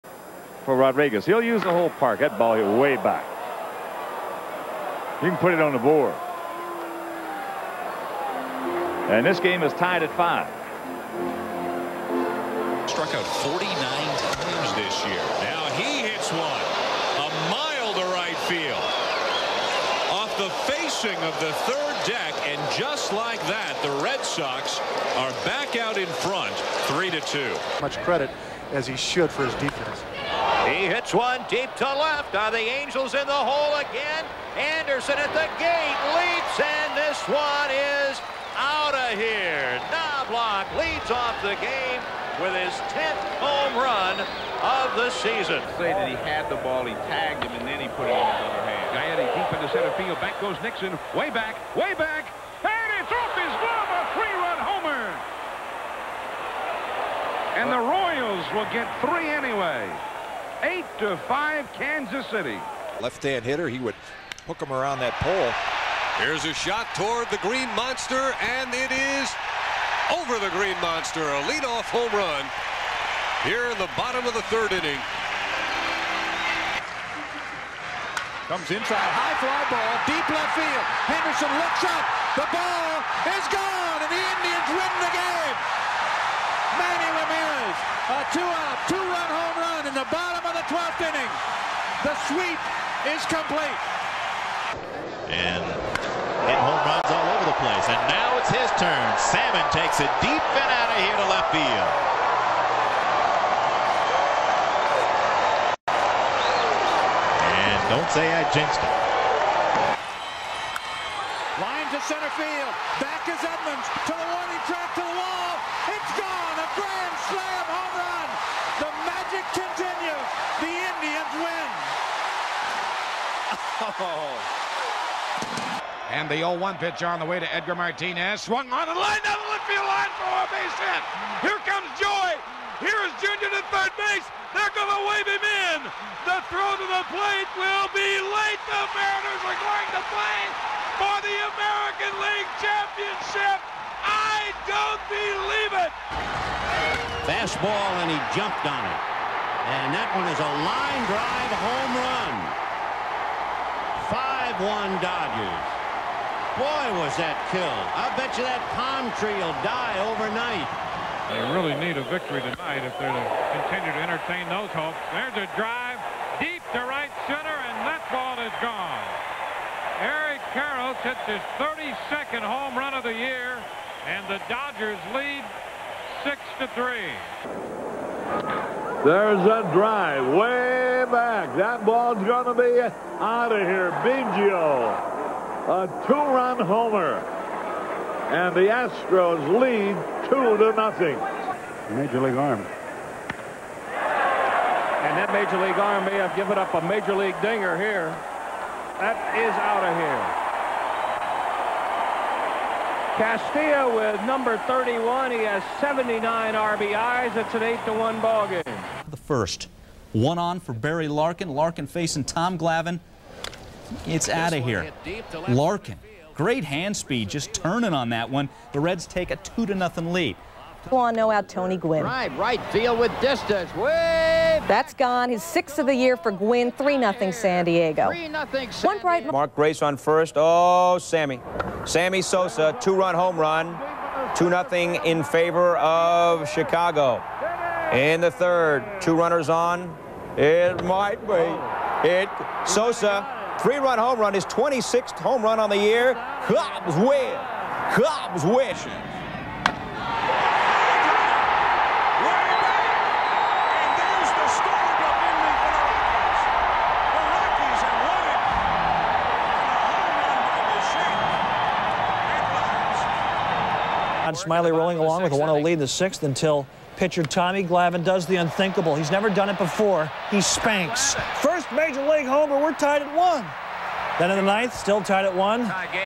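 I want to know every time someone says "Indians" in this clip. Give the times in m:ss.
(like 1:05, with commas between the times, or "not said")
1:24, 2:00.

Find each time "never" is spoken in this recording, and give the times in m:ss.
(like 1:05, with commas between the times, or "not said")
4:29.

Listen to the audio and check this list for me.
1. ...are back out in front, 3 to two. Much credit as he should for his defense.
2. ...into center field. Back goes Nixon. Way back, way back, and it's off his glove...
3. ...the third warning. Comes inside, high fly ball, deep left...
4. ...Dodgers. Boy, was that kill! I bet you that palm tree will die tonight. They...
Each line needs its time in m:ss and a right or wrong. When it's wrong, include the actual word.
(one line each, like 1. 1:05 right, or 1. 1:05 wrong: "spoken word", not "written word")
1. 0:25 right
2. 0:49 right
3. 1:14 wrong: "inning", not "warning"
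4. 2:35 wrong: "overnight", not "tonight".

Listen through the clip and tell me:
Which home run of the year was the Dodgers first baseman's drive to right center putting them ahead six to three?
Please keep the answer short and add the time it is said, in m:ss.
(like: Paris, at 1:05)
32, at 2:51.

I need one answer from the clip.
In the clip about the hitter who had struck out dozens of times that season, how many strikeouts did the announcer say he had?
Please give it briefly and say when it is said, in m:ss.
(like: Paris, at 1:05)
49, at 0:13.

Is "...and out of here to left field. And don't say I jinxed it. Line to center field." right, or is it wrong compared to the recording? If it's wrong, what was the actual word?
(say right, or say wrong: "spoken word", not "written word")
right.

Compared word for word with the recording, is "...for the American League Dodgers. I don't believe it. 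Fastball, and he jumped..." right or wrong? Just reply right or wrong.
wrong.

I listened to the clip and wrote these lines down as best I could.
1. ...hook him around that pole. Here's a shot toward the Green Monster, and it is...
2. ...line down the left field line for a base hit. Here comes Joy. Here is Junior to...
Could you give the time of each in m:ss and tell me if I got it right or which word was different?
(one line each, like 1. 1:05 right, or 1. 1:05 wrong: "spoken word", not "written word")
1. 1:04 right
2. 2:08 right.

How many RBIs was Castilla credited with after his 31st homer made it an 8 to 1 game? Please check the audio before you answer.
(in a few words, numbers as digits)
79.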